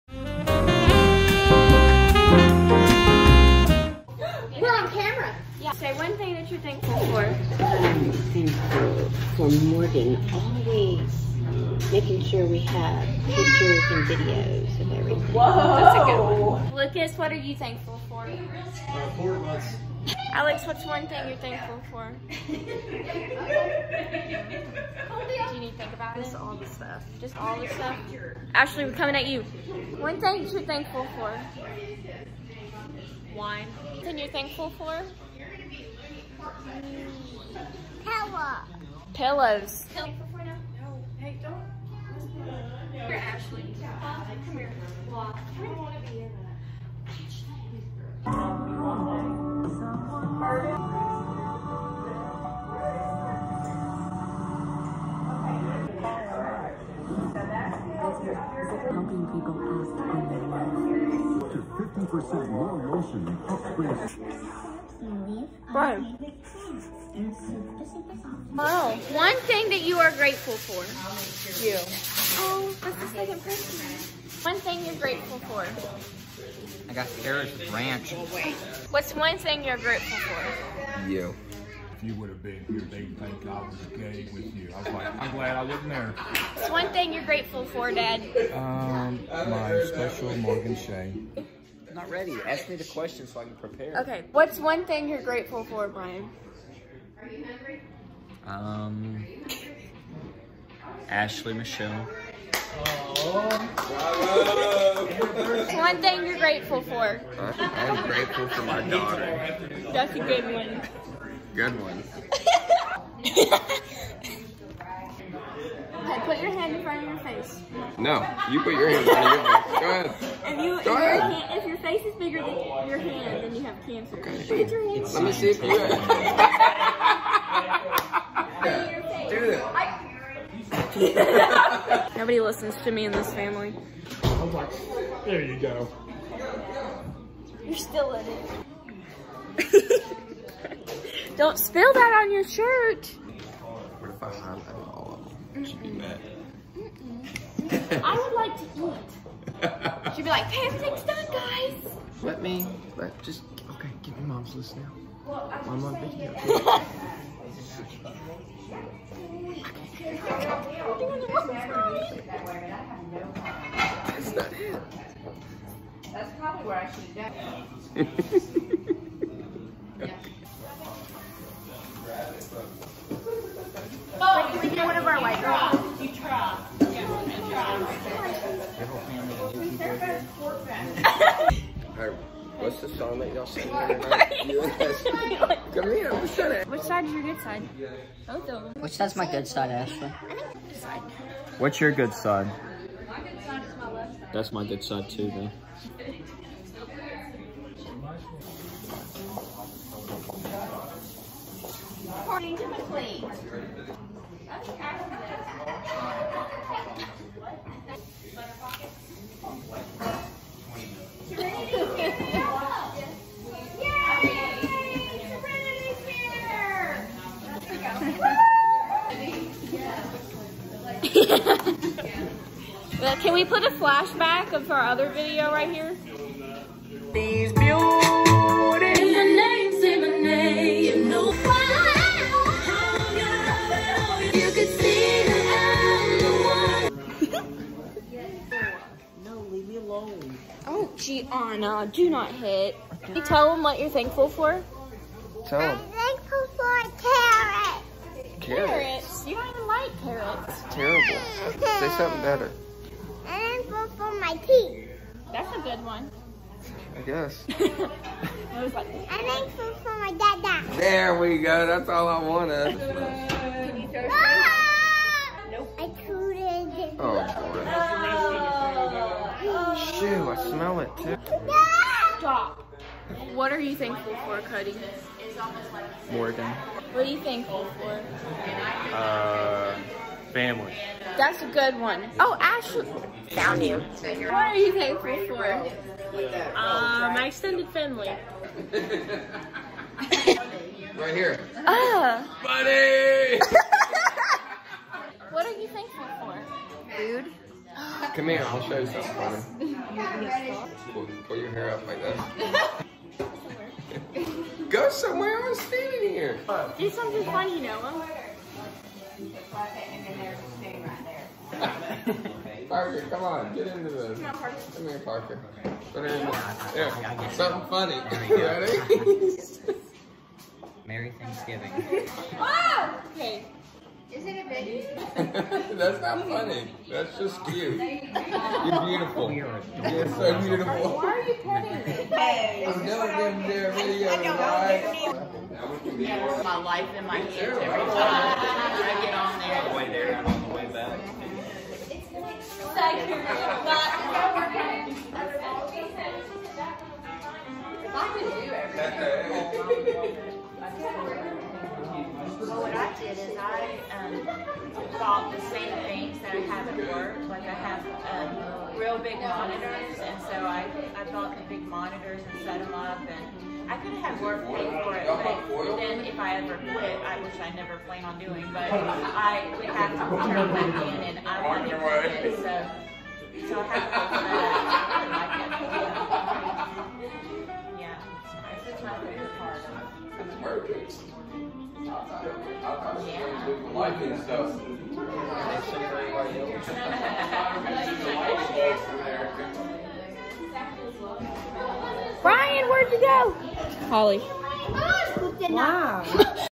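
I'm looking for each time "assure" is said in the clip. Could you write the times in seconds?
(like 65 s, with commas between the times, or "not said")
not said.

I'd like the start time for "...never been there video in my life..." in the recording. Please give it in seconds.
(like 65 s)
332 s.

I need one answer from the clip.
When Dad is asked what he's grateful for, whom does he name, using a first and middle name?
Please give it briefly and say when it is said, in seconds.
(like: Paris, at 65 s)
Morgan Shay, at 90 s.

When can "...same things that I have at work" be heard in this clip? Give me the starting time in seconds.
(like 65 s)
355 s.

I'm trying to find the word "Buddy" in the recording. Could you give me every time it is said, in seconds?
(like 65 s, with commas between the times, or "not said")
292 s.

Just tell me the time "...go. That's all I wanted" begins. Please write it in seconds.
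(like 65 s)
261 s.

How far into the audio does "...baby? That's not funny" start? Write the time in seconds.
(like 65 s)
324 s.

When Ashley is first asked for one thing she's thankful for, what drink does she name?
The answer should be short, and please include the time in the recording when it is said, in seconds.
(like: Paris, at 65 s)
Wine, at 33 s.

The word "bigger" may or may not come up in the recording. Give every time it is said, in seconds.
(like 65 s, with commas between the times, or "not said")
122 s.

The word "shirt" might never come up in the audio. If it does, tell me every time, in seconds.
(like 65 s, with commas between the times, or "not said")
142 s.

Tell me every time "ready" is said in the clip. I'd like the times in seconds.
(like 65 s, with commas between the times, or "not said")
92 s, 318 s.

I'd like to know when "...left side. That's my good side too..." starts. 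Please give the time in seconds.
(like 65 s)
193 s.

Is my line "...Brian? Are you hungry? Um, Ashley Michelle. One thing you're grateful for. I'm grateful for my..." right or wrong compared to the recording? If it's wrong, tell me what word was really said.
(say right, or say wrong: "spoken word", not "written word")
right.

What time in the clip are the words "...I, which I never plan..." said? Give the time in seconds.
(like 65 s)
367 s.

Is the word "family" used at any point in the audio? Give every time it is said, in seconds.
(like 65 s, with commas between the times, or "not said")
133 s, 280 s, 287 s.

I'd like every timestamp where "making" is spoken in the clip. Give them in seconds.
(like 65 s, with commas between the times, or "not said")
11 s.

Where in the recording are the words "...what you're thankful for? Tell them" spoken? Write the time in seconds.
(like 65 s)
243 s.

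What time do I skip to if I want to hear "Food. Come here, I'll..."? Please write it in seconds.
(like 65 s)
296 s.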